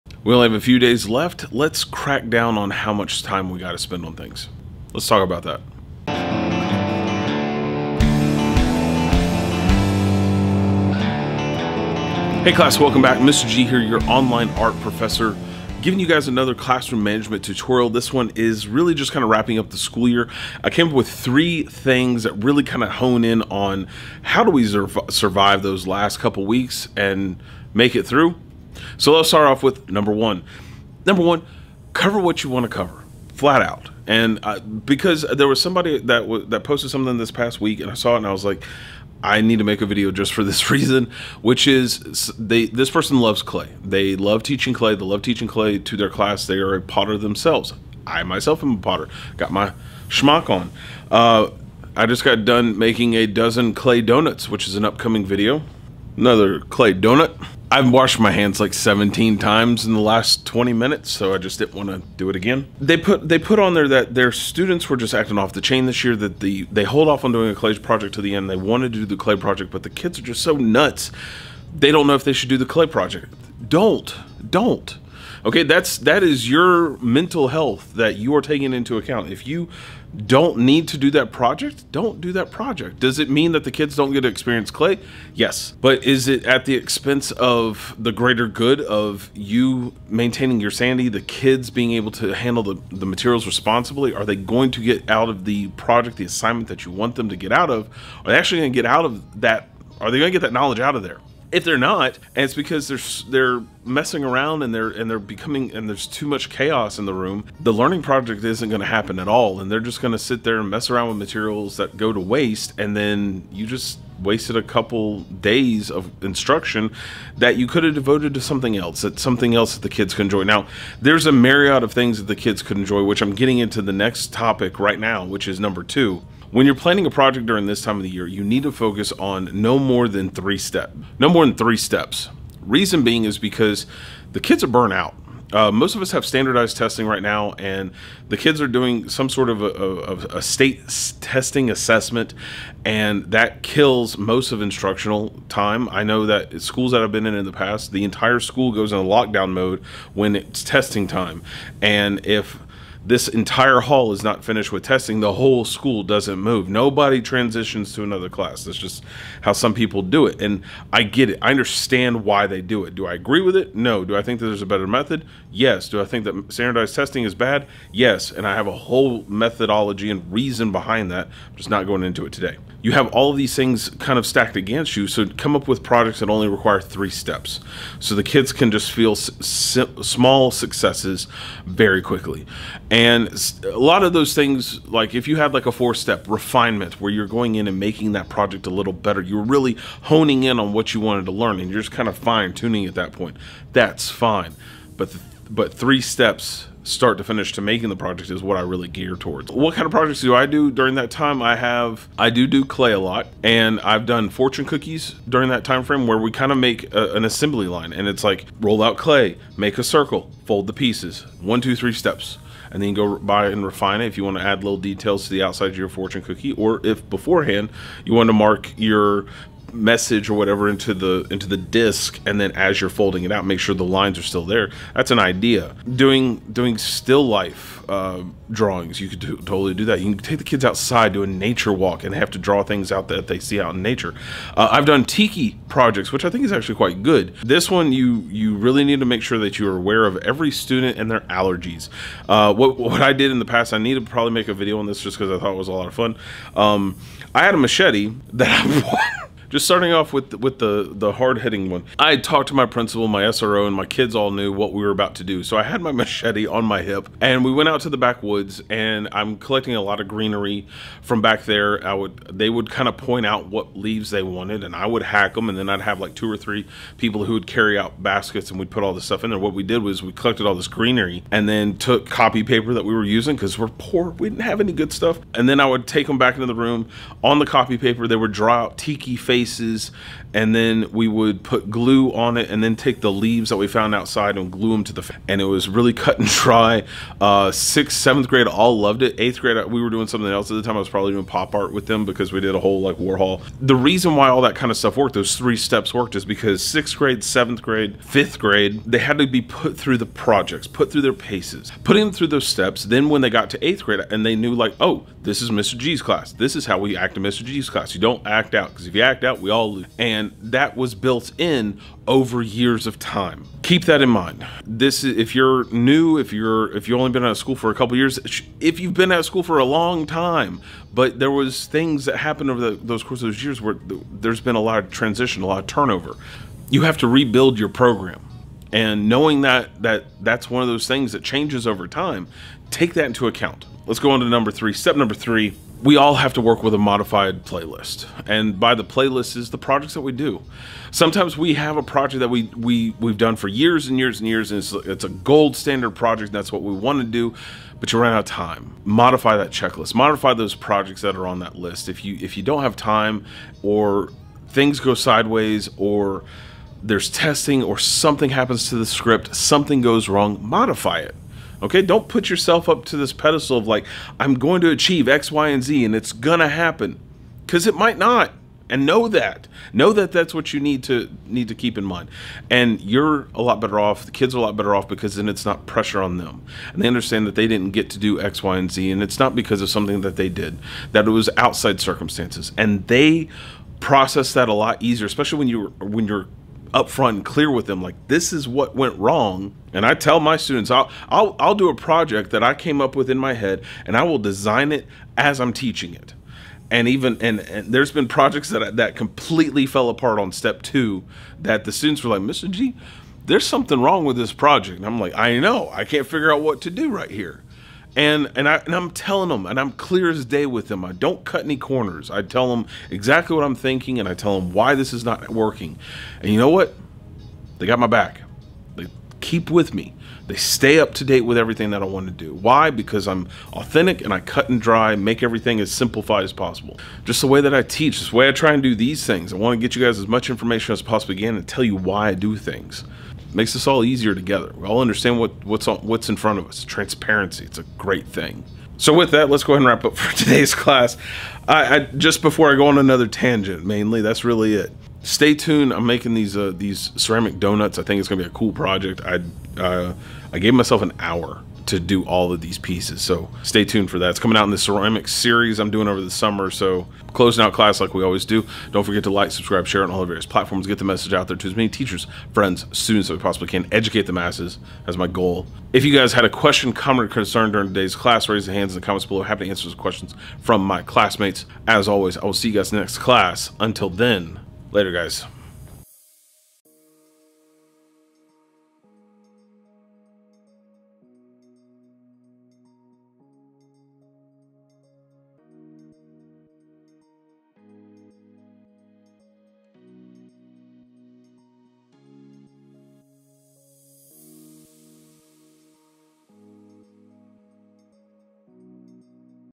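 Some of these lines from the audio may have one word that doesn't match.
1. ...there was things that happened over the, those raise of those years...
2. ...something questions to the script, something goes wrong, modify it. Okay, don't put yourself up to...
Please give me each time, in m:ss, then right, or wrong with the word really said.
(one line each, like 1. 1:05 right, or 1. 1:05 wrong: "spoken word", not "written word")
1. 5:21 wrong: "course", not "raise"
2. 5:57 wrong: "happens", not "questions".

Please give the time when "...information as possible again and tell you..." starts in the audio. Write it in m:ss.
7:10.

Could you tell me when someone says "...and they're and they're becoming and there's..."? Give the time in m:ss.
1:44.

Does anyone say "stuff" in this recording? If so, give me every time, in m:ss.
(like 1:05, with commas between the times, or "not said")
4:29, 4:34, 4:54.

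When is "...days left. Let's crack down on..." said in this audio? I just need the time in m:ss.
0:00.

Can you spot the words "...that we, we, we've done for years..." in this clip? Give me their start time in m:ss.
5:42.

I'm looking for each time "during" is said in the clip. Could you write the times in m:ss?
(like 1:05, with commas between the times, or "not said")
2:07, 3:20, 3:25, 7:47.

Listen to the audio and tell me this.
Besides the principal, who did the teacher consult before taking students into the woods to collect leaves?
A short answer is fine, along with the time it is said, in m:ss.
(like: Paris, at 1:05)
SRO, at 4:13.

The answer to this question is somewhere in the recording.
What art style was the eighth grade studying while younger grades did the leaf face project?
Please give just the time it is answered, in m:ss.
4:51.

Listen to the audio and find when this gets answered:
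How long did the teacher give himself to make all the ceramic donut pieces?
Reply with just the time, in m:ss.
7:30.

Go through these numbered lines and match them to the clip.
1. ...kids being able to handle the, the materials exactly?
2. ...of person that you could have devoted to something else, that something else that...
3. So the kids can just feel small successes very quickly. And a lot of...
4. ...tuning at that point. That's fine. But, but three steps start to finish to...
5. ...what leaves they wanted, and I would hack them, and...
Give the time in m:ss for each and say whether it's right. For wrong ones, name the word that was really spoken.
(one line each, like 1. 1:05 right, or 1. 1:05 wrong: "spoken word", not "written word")
1. 1:31 wrong: "responsibly", not "exactly"
2. 1:55 wrong: "instruction", not "person"
3. 2:57 right
4. 3:12 right
5. 4:23 right.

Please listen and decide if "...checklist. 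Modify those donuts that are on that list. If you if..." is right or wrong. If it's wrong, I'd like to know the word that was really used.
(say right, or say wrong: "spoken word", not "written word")
wrong: "projects", not "donuts".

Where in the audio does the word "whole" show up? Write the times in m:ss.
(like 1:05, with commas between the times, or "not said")
2:35, 2:48, 4:52.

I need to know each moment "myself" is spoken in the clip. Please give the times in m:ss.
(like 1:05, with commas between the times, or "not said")
0:48, 7:30.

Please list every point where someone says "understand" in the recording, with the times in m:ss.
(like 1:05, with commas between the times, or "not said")
2:41, 6:16, 7:14.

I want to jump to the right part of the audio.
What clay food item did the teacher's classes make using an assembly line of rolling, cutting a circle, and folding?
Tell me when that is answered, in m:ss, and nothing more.
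3:24.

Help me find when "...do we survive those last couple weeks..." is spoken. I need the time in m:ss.
0:24.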